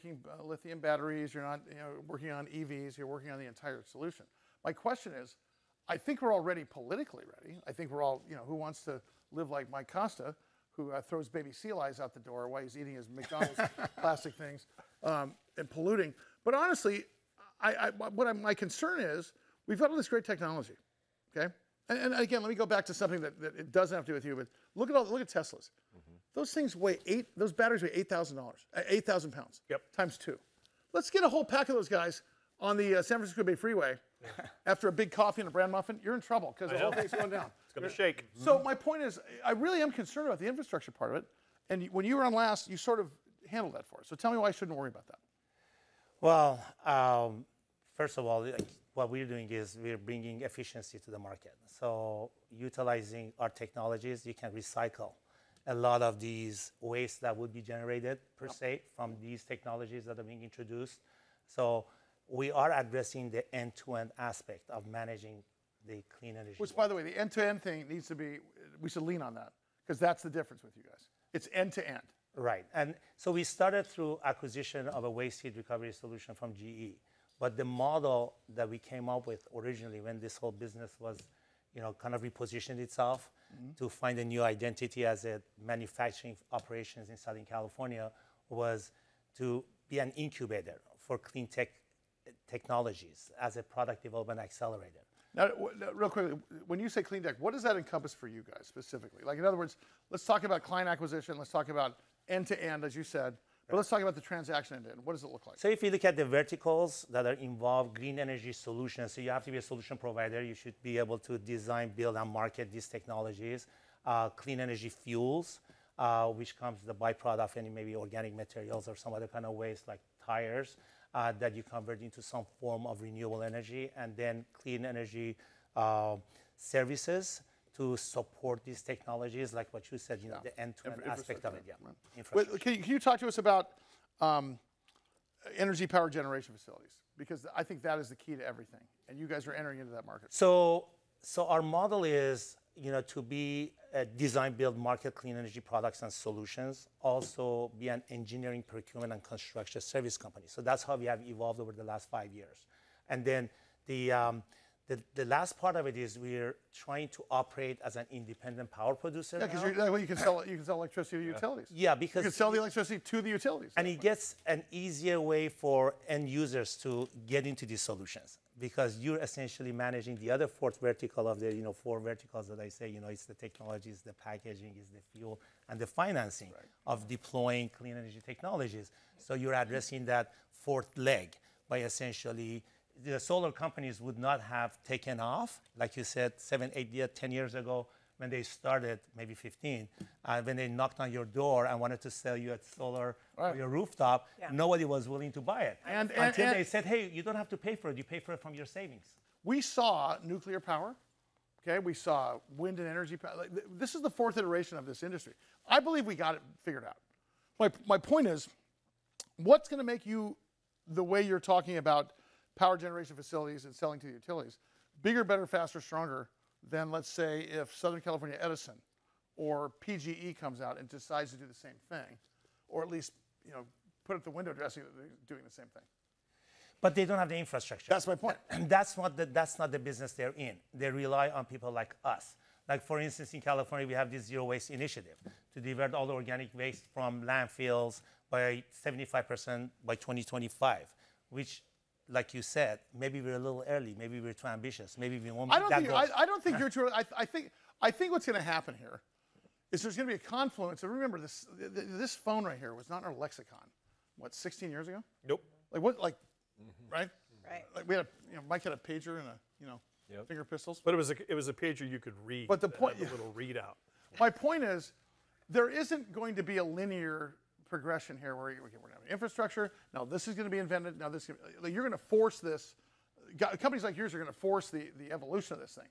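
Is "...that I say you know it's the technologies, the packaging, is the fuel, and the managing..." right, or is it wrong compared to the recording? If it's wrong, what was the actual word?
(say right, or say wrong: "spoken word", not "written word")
wrong: "financing", not "managing".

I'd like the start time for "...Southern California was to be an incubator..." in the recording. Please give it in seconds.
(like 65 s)
87 s.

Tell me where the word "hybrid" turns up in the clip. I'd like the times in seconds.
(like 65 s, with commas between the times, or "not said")
not said.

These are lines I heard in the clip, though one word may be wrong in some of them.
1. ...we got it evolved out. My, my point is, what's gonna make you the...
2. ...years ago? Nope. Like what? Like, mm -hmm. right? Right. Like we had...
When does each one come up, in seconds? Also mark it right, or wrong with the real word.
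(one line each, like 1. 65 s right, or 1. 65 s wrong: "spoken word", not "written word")
1. 206 s wrong: "figured", not "evolved"
2. 254 s right.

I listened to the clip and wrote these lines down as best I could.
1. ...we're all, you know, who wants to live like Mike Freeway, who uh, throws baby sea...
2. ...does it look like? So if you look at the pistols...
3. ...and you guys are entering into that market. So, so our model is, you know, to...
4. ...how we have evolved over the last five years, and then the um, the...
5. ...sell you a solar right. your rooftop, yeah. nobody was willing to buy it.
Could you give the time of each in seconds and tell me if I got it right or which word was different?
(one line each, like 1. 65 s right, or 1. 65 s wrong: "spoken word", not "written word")
1. 7 s wrong: "Costa", not "Freeway"
2. 105 s wrong: "verticals", not "pistols"
3. 139 s right
4. 150 s right
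5. 192 s right.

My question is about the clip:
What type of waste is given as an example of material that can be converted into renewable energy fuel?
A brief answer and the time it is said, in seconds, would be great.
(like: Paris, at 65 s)
tires, at 120 s.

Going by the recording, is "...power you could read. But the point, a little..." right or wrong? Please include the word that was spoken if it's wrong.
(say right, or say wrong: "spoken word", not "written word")
wrong: "pager", not "power".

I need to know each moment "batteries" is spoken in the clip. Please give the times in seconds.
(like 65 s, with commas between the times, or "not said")
0 s, 27 s.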